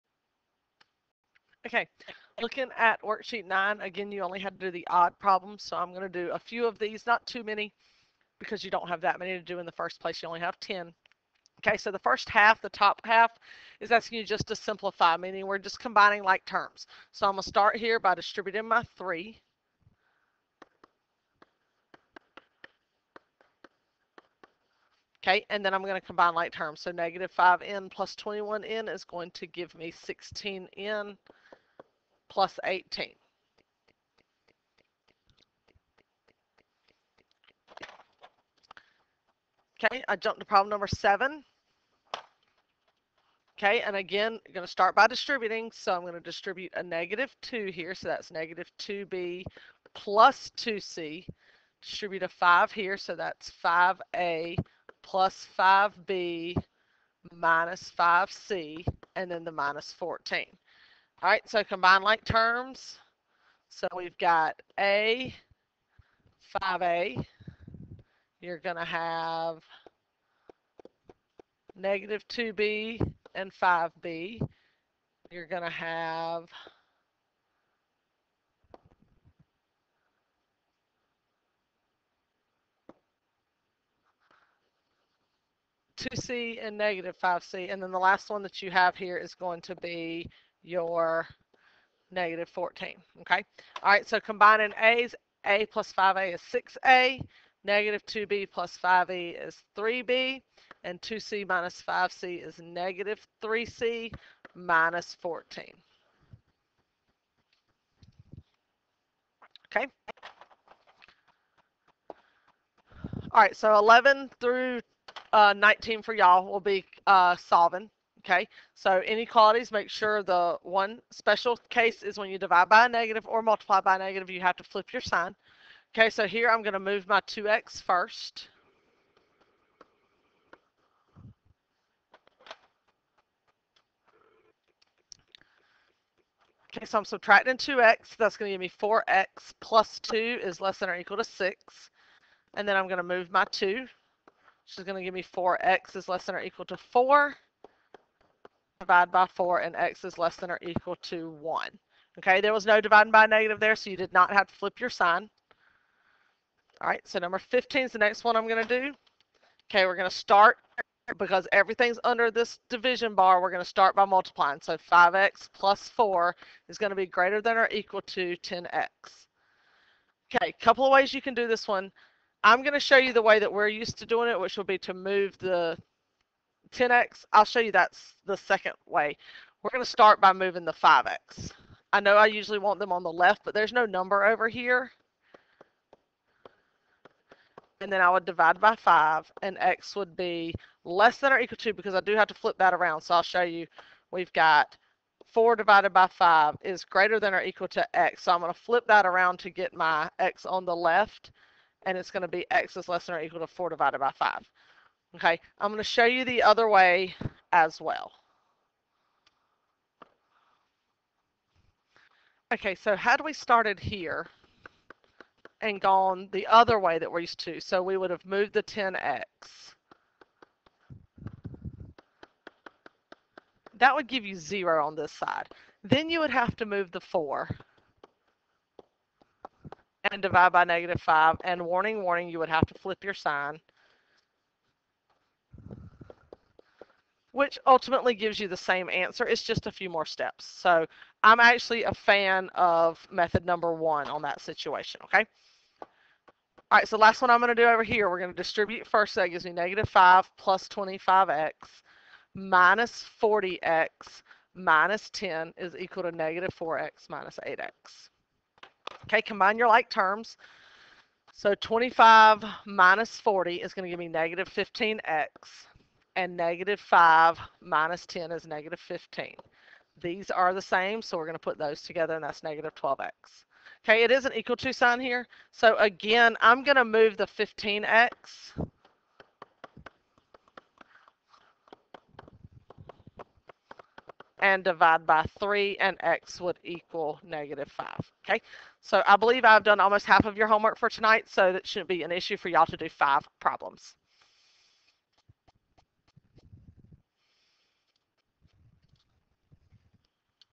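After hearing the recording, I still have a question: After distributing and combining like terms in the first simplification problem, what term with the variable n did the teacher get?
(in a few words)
16n.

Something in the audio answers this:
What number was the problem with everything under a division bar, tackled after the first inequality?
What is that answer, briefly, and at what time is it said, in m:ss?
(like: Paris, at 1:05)
15, at 2:37.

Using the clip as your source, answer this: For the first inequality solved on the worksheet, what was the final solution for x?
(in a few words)
x ≤ 1.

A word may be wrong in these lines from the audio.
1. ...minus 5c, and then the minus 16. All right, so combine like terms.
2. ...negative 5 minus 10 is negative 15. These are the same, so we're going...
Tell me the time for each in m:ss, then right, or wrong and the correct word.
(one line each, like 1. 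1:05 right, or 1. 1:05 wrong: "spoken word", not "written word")
1. 0:57 wrong: "14", not "16"
2. 4:26 right.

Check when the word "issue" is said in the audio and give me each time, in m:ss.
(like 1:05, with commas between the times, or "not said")
4:52.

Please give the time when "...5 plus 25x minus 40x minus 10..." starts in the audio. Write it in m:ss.
4:09.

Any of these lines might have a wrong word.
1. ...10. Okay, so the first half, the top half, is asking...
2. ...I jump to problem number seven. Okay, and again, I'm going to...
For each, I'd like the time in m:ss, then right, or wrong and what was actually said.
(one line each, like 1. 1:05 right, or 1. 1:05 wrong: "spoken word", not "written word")
1. 0:10 right
2. 0:40 right.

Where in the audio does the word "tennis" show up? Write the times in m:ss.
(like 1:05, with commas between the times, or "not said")
not said.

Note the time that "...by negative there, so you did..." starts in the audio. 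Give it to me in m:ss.
2:33.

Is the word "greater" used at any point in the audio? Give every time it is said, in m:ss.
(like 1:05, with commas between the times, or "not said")
2:47, 3:16.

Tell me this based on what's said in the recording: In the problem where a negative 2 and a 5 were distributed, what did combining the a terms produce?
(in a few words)
6A.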